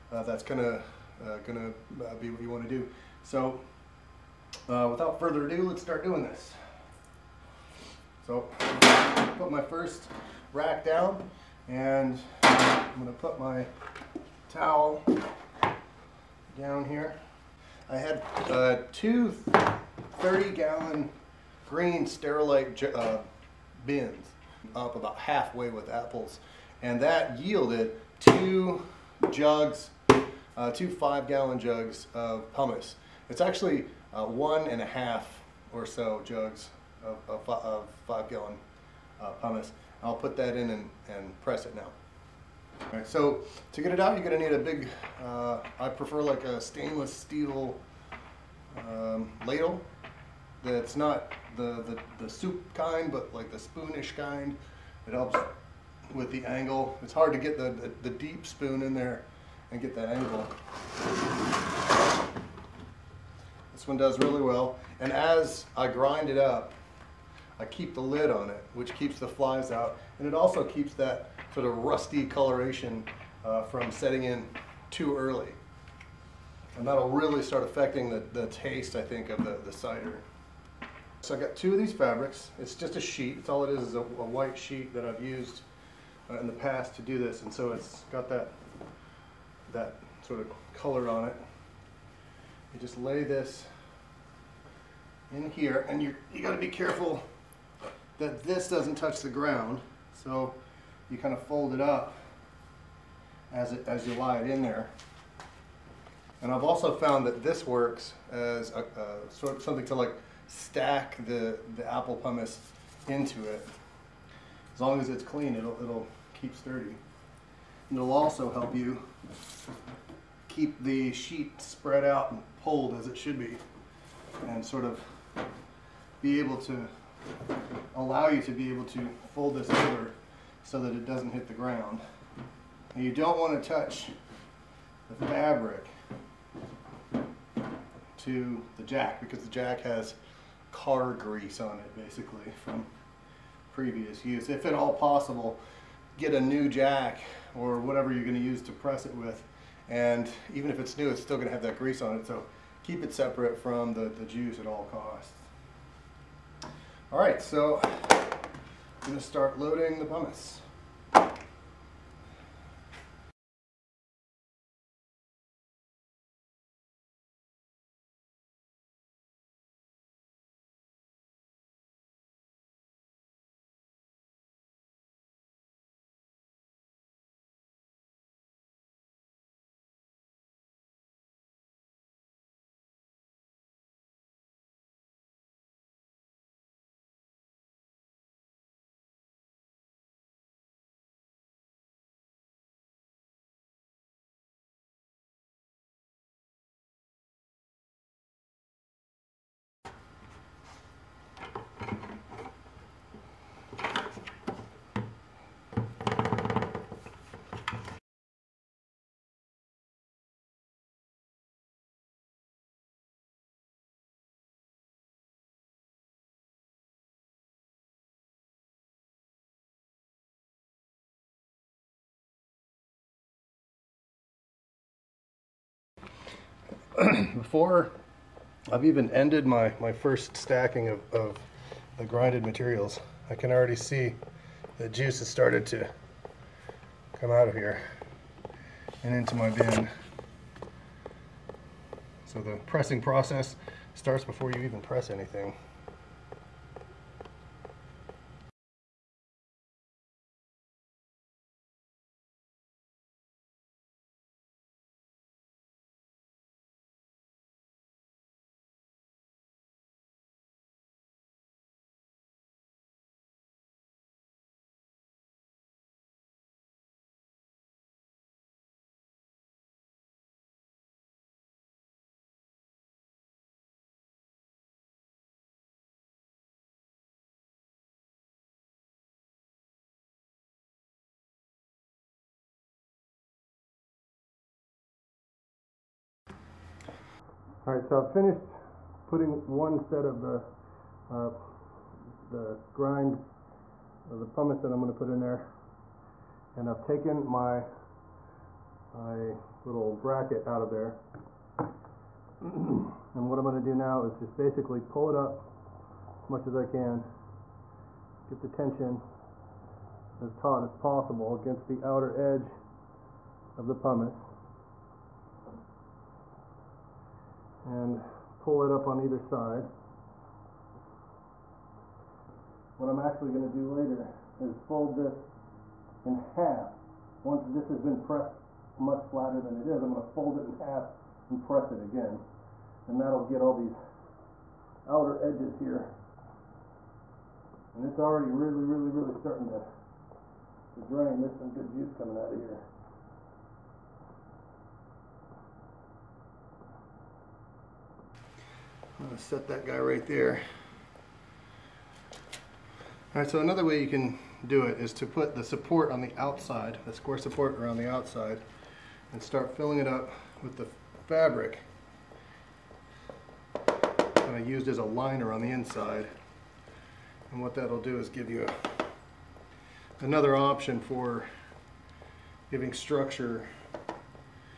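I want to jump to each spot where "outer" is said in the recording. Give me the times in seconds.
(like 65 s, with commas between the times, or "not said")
311 s, 334 s.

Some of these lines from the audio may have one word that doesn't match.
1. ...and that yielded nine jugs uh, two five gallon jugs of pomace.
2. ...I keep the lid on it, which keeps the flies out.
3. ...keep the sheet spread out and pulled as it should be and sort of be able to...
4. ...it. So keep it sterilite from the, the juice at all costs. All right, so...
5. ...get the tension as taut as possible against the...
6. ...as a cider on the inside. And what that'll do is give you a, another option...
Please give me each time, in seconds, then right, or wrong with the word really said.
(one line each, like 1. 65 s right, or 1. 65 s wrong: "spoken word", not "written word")
1. 26 s wrong: "two", not "nine"
2. 67 s right
3. 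120 s right
4. 152 s wrong: "separate", not "sterilite"
5. 308 s right
6. 364 s wrong: "liner", not "cider".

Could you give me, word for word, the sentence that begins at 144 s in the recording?
If at all possible, get a new jack or whatever you're going to use to press it with.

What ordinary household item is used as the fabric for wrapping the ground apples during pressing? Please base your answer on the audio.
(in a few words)
A white sheet.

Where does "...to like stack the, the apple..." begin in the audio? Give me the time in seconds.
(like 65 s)
109 s.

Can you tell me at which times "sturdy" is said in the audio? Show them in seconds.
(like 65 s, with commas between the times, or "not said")
116 s.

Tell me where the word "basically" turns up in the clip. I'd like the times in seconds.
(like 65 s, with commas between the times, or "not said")
141 s, 304 s.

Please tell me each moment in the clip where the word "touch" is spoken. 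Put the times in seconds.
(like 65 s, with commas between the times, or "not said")
98 s, 133 s.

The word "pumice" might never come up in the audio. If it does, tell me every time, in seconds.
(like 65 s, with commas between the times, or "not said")
294 s, 313 s.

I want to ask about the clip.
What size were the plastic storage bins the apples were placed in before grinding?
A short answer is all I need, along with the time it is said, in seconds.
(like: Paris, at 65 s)
30 gallon, at 20 s.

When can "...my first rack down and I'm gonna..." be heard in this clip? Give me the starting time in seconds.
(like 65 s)
9 s.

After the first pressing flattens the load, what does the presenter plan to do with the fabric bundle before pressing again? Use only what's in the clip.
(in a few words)
Fold it in half.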